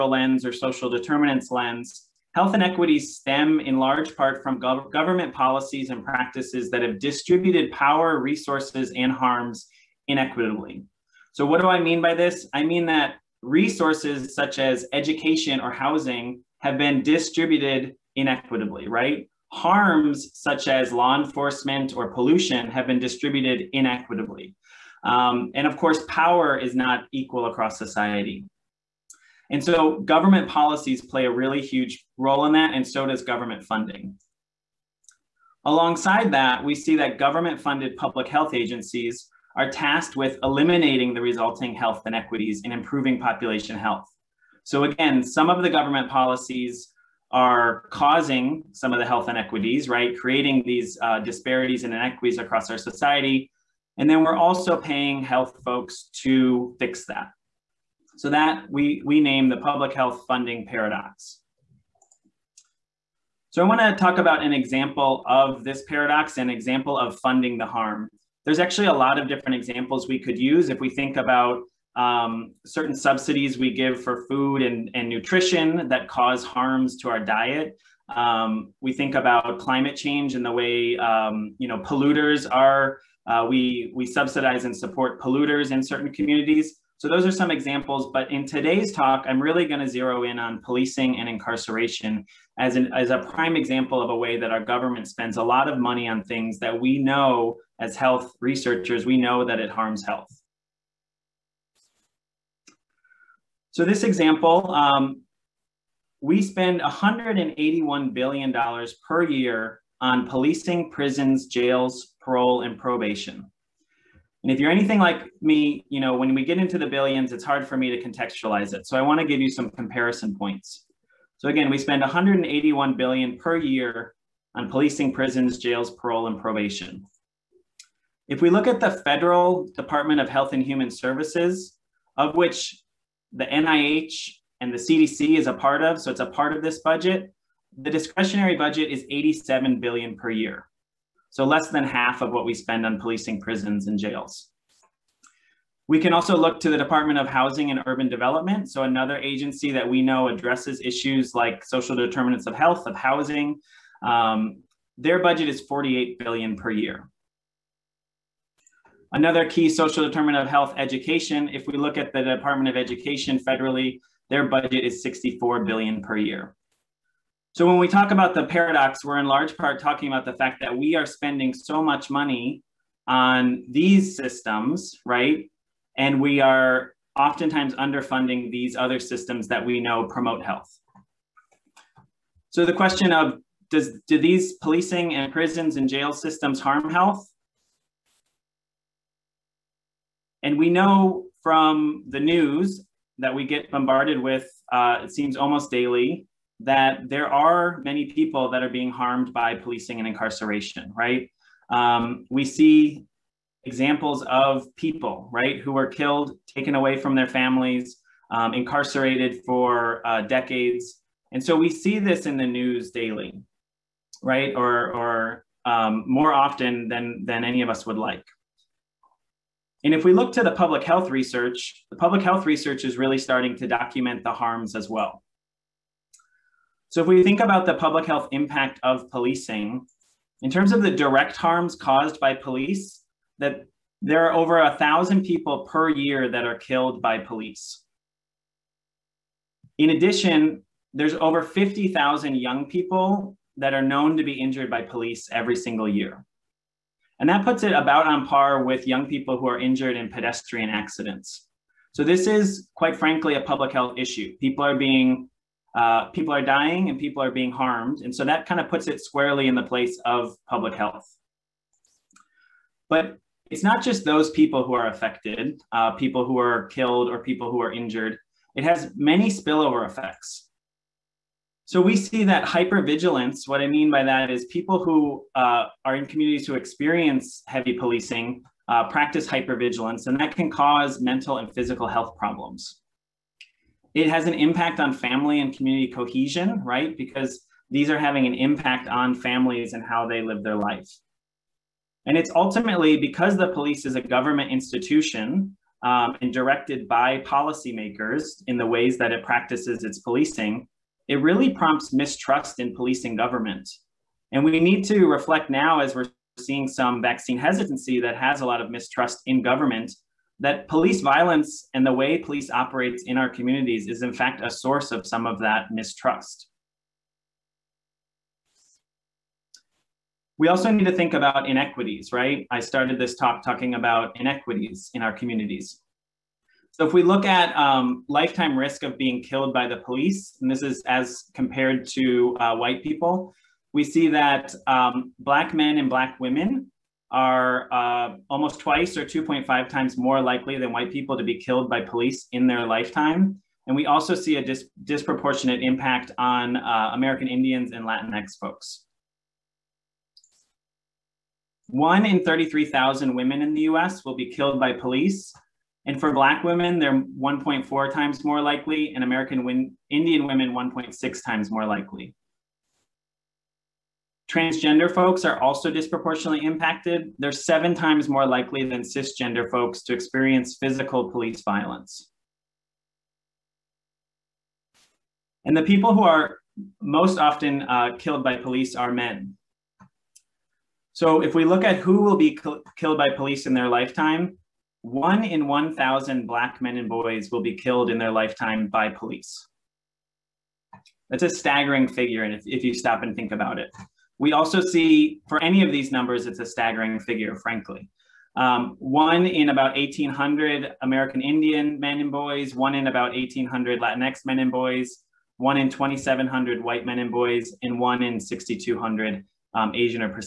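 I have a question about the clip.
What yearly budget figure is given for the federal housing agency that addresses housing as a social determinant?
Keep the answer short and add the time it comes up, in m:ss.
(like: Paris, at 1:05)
48 billion, at 2:35.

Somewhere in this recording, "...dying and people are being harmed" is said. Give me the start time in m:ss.
4:16.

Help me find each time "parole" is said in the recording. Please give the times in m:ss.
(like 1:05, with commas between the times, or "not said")
1:52, 2:05.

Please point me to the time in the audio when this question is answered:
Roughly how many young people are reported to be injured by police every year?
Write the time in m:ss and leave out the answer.
4:01.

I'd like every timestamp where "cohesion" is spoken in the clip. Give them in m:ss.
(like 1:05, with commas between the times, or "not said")
4:45.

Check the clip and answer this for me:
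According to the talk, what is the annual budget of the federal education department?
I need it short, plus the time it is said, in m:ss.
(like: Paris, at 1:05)
64 billion, at 2:45.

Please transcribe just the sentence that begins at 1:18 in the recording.
Um, we think about climate change and the way um, you know polluters are.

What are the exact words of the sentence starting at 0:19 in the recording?
Harms such as law enforcement or pollution have been distributed inequitably.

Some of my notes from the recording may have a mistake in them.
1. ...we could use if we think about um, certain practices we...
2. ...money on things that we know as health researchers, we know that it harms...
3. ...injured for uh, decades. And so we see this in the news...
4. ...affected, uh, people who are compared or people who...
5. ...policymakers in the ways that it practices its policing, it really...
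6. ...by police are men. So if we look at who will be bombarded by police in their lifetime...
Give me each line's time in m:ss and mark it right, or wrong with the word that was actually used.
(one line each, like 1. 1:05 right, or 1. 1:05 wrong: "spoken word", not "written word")
1. 1:10 wrong: "subsidies", not "practices"
2. 1:35 right
3. 3:28 wrong: "incarcerated", not "injured"
4. 4:24 wrong: "killed", not "compared"
5. 4:57 right
6. 6:18 wrong: "killed", not "bombarded".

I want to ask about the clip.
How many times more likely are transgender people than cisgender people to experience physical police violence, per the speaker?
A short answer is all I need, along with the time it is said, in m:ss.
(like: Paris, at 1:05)
7, at 6:07.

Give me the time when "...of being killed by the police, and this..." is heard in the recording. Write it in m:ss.
5:28.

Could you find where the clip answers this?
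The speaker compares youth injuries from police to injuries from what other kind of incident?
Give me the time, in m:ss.
4:10.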